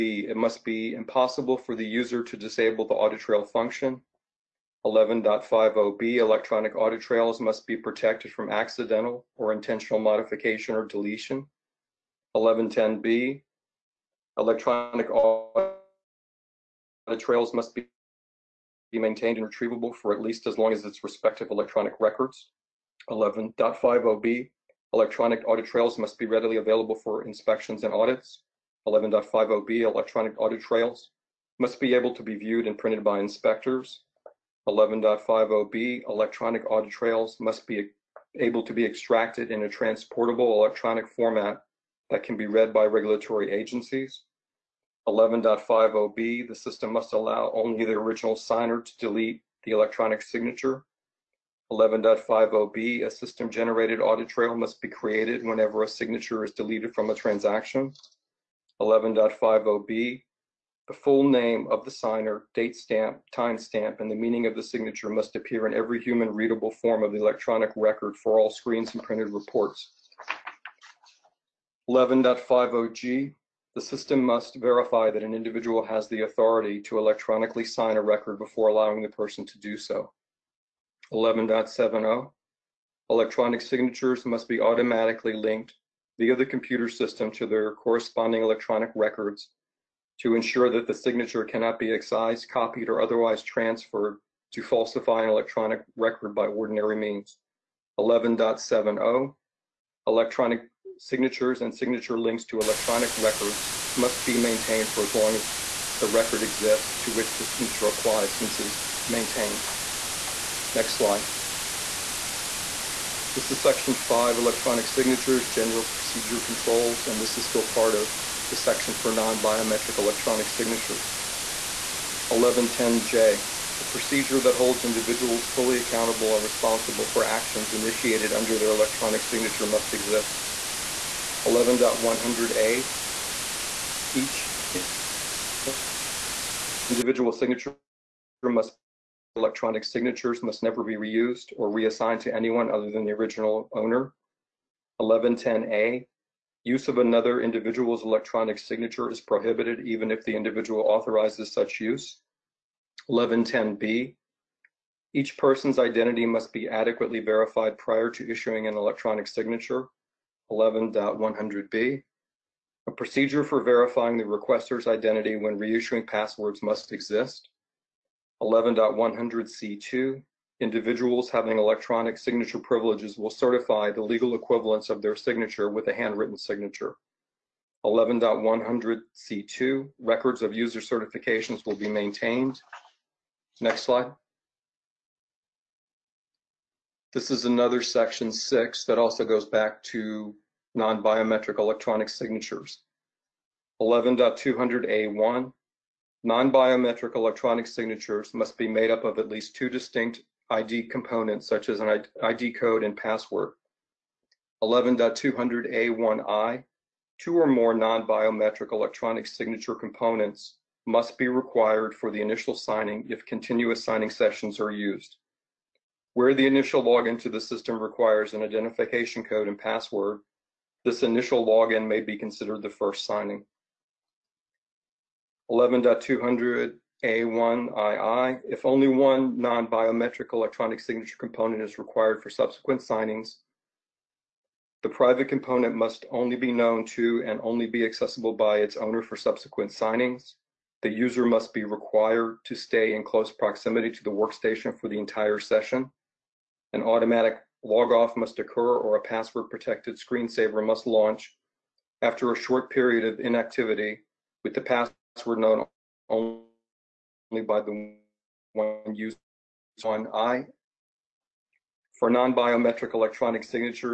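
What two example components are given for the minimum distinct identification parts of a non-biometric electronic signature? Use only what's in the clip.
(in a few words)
ID code and password.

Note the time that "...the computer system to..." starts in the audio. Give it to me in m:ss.
1:26.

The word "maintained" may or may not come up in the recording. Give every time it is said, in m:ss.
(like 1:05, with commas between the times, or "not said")
0:18, 1:44, 1:49, 3:01.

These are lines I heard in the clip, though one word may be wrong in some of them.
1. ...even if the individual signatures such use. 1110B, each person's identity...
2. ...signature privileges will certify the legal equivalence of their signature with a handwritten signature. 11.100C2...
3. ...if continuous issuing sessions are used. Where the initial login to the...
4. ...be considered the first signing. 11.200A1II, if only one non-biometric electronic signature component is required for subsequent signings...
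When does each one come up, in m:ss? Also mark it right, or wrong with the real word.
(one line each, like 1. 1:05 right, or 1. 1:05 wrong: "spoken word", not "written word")
1. 2:29 wrong: "authorizes", not "signatures"
2. 2:52 right
3. 3:33 wrong: "signing", not "issuing"
4. 3:41 right.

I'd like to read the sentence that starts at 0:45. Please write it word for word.
11.50b, the system must allow only the original signer to delete the electronic signature.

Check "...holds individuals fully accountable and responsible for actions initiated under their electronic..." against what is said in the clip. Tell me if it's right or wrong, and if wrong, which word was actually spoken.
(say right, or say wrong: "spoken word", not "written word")
right.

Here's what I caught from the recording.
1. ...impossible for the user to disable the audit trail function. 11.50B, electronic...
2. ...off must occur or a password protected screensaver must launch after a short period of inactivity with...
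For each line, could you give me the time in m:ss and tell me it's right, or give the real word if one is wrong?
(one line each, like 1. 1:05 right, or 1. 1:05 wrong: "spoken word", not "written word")
1. 0:00 right
2. 4:07 right.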